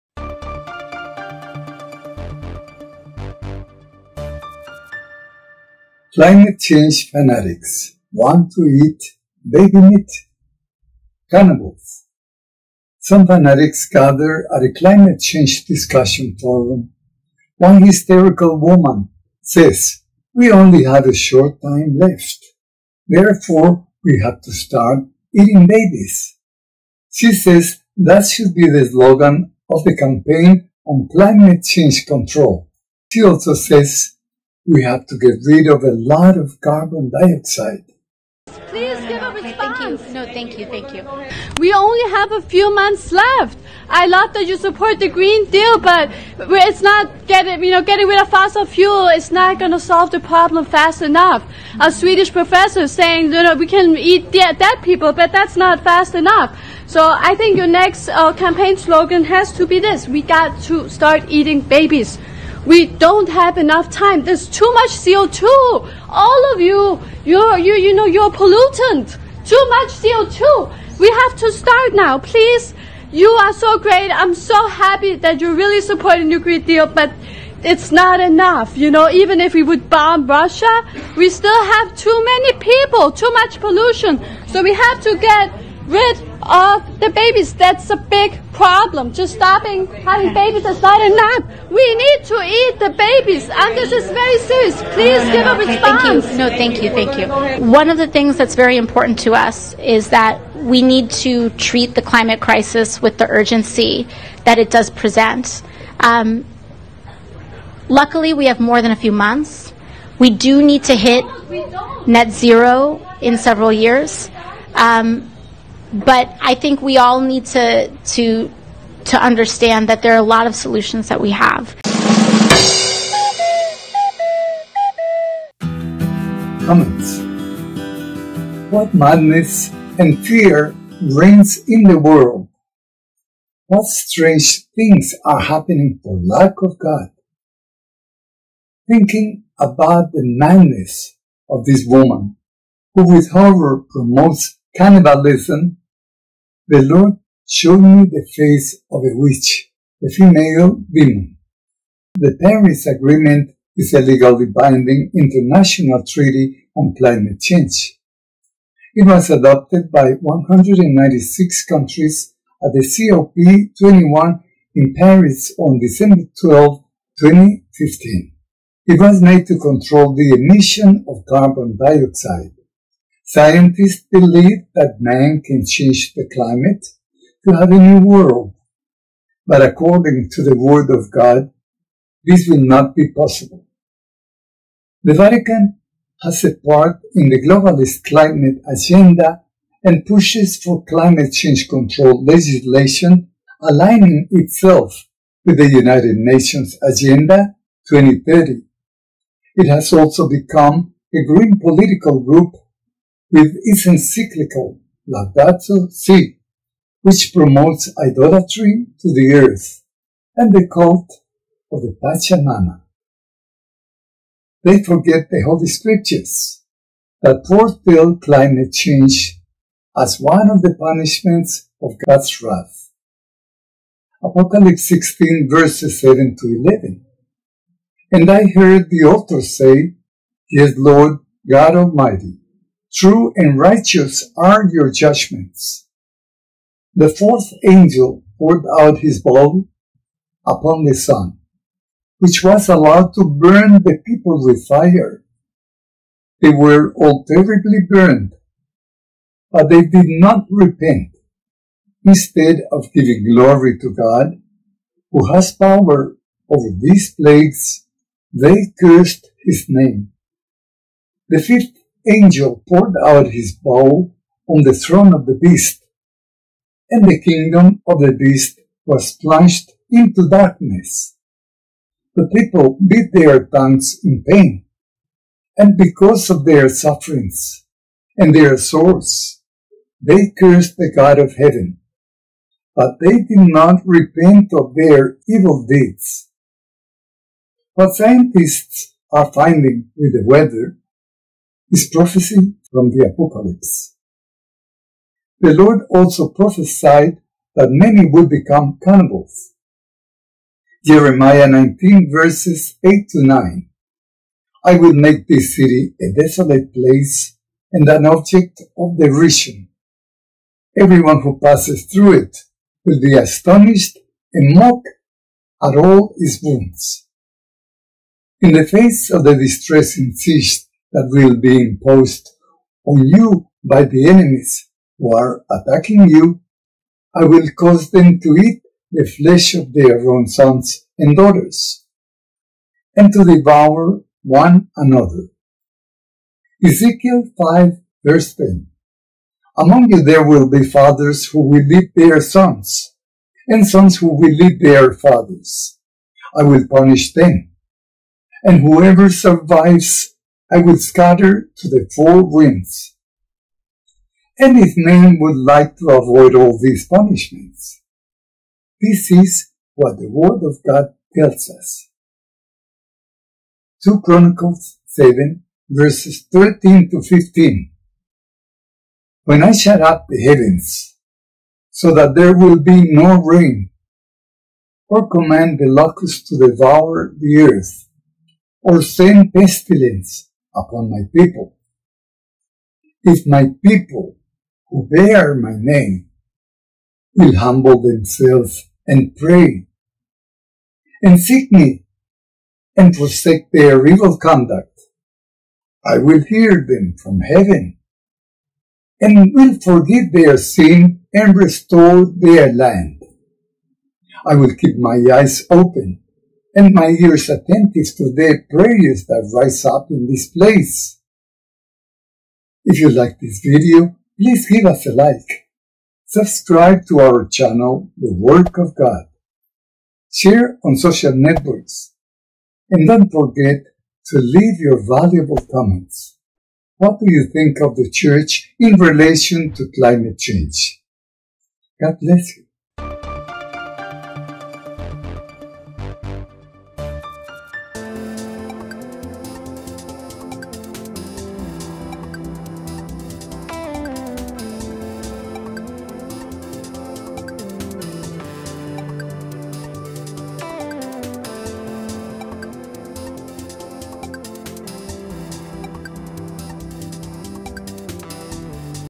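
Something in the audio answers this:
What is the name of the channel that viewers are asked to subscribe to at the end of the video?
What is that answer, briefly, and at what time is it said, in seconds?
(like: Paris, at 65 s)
The Work of God, at 417 s.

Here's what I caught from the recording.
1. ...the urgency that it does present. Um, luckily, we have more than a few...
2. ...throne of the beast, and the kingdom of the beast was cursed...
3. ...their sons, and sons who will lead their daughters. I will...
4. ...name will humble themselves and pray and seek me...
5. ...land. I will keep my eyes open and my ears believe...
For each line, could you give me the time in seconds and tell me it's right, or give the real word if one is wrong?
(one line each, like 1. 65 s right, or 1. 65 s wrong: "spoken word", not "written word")
1. 103 s right
2. 264 s wrong: "plunged", not "cursed"
3. 341 s wrong: "fathers", not "daughters"
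4. 385 s right
5. 402 s wrong: "attentive", not "believe".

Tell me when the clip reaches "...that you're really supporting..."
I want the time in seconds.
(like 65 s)
75 s.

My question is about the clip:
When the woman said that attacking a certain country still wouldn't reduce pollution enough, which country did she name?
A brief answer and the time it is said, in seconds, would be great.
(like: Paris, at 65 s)
Russia, at 80 s.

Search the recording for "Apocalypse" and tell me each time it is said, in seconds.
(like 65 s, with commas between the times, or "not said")
224 s, 293 s.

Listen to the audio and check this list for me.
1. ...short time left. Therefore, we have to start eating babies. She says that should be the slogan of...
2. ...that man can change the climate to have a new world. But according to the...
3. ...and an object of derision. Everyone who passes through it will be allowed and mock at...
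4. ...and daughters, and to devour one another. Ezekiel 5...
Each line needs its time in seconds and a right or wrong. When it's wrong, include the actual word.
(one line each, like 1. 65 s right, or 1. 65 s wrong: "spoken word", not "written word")
1. 21 s right
2. 174 s right
3. 307 s wrong: "astonished", not "allowed"
4. 330 s right.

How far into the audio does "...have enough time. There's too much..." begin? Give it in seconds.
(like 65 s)
63 s.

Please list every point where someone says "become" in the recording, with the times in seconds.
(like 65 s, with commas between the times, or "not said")
200 s, 298 s.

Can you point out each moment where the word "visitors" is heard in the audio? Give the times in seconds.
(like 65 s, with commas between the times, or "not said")
not said.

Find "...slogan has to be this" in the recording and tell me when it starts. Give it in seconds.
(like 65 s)
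58 s.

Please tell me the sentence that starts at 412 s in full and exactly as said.
If you like this video, please give us a like.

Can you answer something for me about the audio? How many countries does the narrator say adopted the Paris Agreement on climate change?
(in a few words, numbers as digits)
196.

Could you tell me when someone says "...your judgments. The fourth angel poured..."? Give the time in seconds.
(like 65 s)
234 s.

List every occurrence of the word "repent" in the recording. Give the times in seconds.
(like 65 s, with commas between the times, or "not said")
250 s, 283 s.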